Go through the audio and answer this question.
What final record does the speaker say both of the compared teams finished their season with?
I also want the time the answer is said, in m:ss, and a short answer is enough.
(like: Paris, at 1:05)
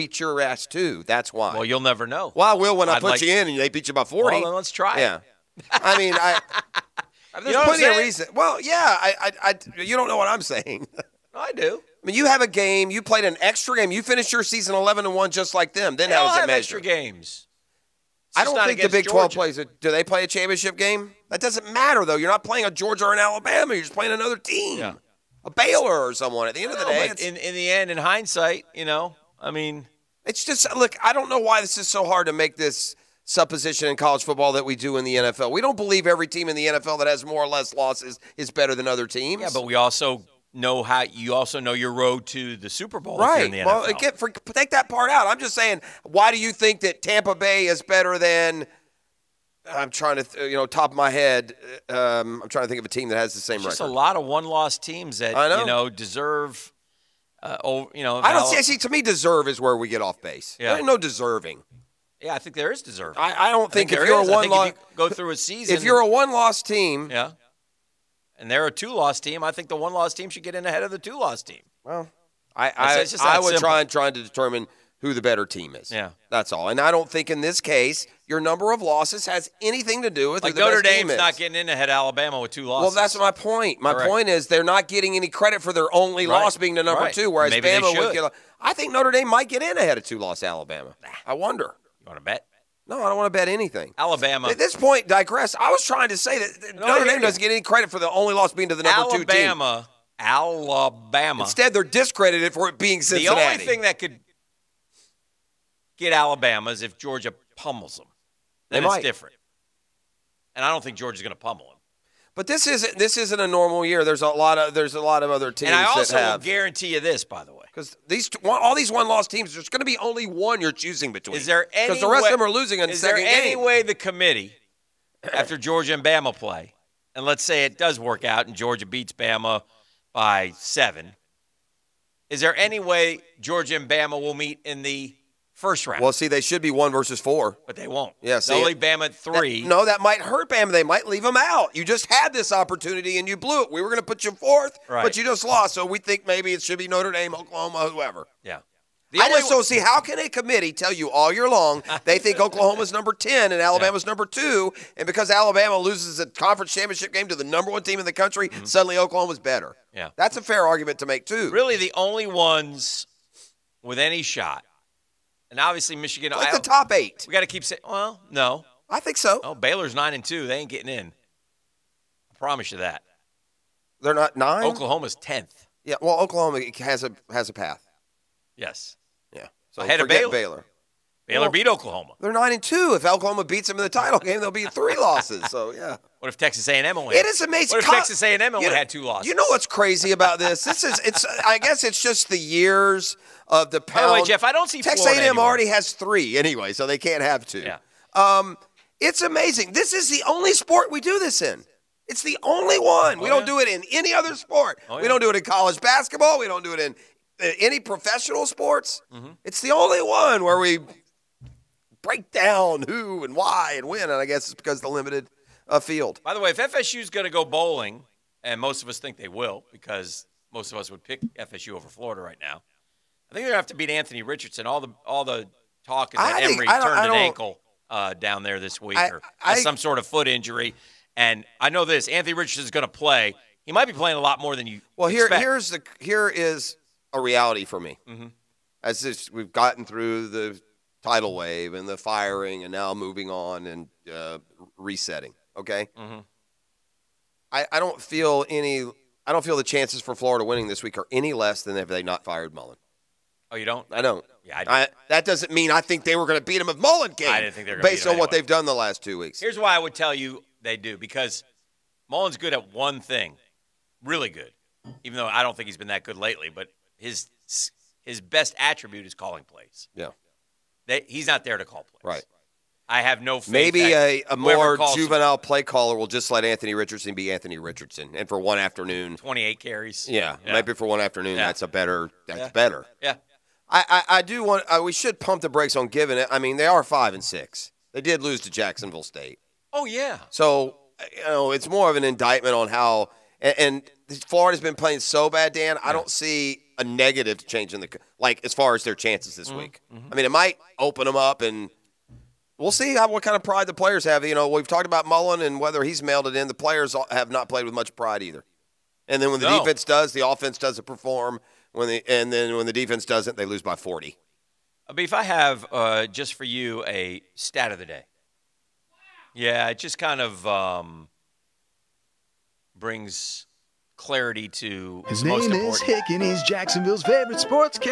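11 and 1, at 0:14.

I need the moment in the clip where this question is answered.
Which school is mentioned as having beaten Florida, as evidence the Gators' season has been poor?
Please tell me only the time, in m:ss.
4:48.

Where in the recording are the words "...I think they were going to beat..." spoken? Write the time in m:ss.
4:15.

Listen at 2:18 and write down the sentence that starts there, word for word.
Yeah, see, only Bama at three.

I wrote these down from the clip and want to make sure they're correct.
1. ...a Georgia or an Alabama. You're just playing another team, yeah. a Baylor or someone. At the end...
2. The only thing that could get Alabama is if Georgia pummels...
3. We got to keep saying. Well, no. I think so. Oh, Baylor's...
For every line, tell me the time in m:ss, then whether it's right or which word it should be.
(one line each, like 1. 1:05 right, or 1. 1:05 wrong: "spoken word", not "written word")
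1. 0:22 right
2. 1:43 right
3. 2:47 right.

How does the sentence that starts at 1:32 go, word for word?
No, I don't want to bet anything.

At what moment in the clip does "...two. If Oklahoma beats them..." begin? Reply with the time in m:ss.
3:02.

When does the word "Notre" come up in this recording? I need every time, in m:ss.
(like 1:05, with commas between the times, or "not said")
1:20, 1:28, 1:36, 2:26.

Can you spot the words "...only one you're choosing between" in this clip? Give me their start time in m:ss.
1:59.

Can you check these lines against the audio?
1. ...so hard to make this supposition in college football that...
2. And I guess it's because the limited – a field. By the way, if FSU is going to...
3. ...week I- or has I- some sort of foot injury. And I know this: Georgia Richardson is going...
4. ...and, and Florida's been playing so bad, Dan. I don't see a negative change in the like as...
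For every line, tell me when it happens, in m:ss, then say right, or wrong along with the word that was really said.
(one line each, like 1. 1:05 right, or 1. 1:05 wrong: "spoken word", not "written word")
1. 0:31 right
2. 3:34 right
3. 3:48 wrong: "Anthony", not "Georgia"
4. 4:53 right.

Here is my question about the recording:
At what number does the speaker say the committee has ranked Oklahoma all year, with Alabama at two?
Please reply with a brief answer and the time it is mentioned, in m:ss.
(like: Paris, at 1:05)
number ten, at 2:32.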